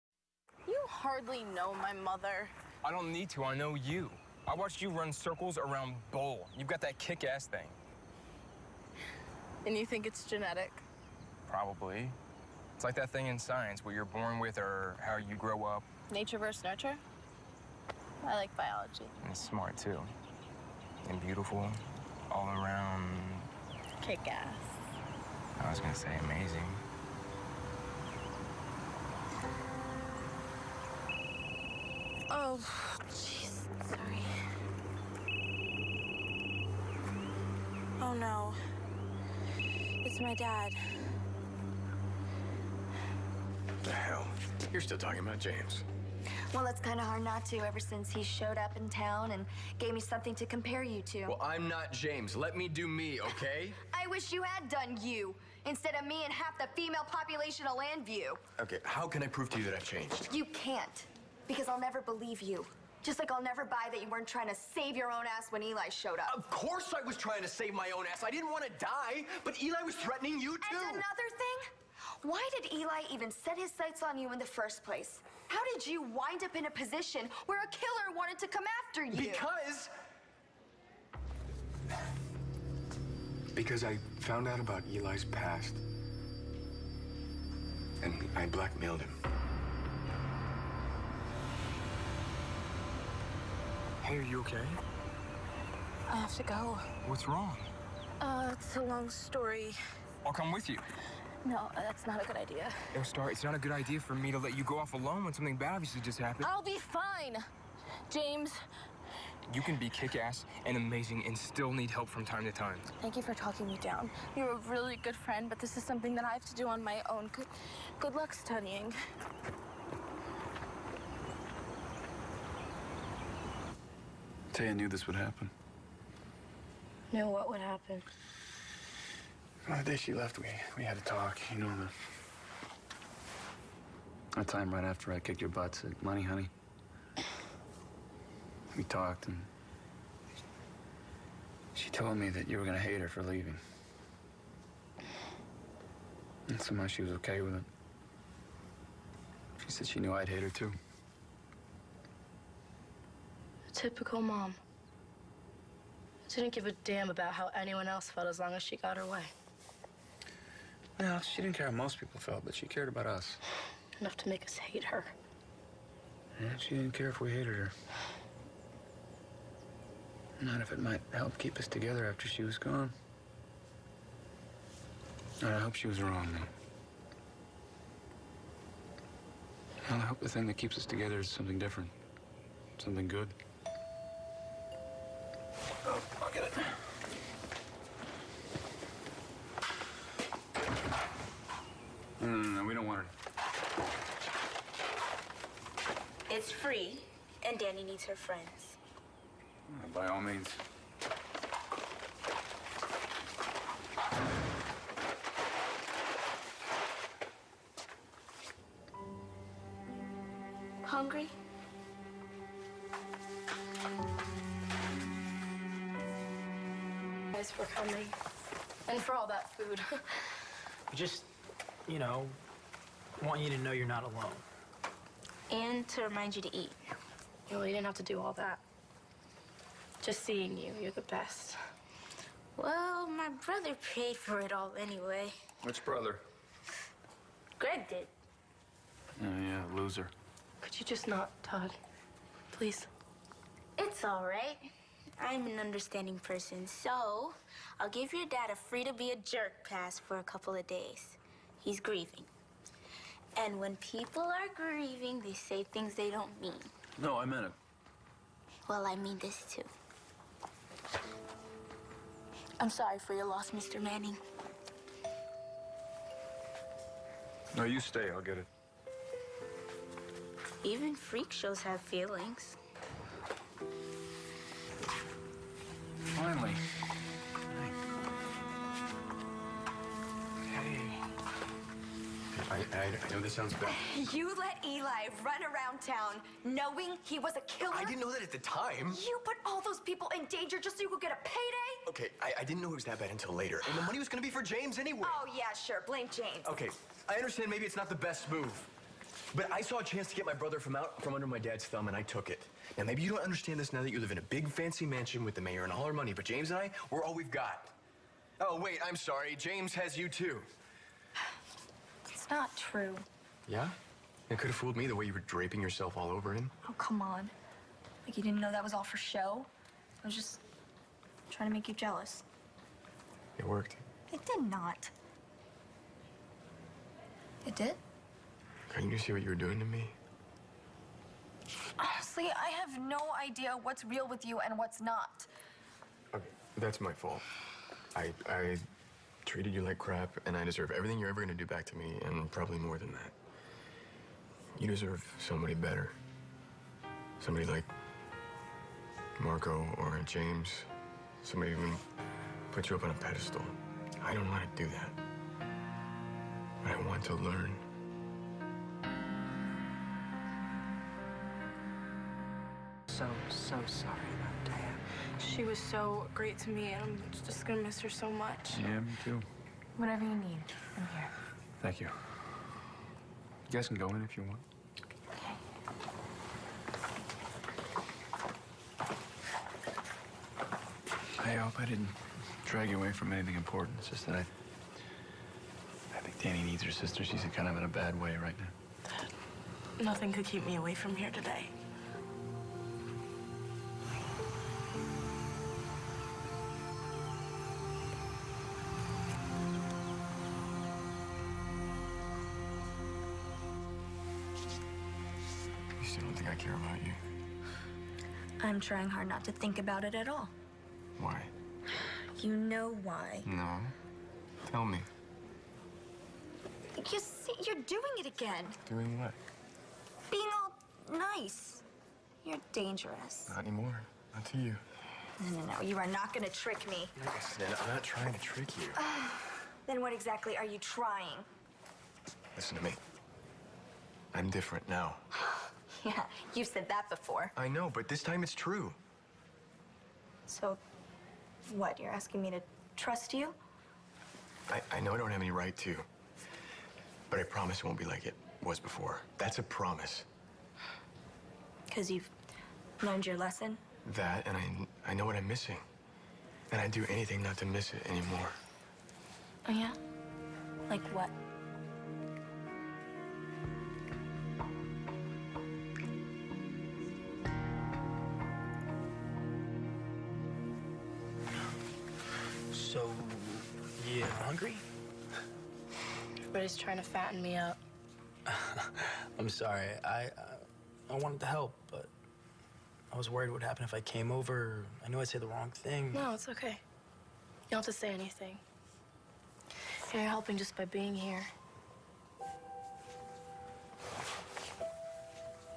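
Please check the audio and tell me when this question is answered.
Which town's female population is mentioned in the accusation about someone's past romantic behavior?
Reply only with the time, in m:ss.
0:57.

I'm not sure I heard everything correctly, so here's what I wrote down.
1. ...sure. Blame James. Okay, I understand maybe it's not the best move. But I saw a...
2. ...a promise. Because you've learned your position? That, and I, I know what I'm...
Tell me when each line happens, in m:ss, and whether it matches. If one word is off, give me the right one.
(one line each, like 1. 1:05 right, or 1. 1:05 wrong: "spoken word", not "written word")
1. 4:55 right
2. 7:29 wrong: "lesson", not "position".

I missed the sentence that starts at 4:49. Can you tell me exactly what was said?
You put all those people in danger just so you could get a payday?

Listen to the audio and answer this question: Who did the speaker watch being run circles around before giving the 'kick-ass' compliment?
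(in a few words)
Bull.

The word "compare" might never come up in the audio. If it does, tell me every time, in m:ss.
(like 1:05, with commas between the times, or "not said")
0:50.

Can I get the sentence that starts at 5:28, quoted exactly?
Couldn't you see what you were doing to me?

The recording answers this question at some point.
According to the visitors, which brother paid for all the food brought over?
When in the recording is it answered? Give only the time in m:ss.
3:57.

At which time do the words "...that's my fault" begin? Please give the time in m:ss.
5:36.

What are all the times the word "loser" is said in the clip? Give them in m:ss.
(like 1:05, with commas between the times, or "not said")
3:59.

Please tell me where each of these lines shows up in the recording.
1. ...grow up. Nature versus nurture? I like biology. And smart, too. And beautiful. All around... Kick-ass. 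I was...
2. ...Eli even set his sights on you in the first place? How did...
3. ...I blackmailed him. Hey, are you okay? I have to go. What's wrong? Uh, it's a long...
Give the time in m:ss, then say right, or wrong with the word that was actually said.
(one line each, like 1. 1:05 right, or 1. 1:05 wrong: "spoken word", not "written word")
1. 0:15 right
2. 1:12 right
3. 1:28 right.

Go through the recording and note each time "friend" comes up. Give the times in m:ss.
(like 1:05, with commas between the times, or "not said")
1:55, 3:18.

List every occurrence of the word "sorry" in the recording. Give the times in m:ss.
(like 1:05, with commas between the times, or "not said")
0:33, 4:22, 5:08, 6:03, 7:59.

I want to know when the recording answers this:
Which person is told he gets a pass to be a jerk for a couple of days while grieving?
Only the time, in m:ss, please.
4:23.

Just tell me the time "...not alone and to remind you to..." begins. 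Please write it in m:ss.
3:43.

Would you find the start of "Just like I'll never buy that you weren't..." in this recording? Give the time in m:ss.
1:03.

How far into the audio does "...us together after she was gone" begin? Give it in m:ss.
2:51.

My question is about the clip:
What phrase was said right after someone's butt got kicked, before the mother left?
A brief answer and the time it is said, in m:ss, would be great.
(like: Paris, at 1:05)
Money Honey, at 2:16.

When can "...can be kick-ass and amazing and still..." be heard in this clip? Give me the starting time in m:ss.
1:49.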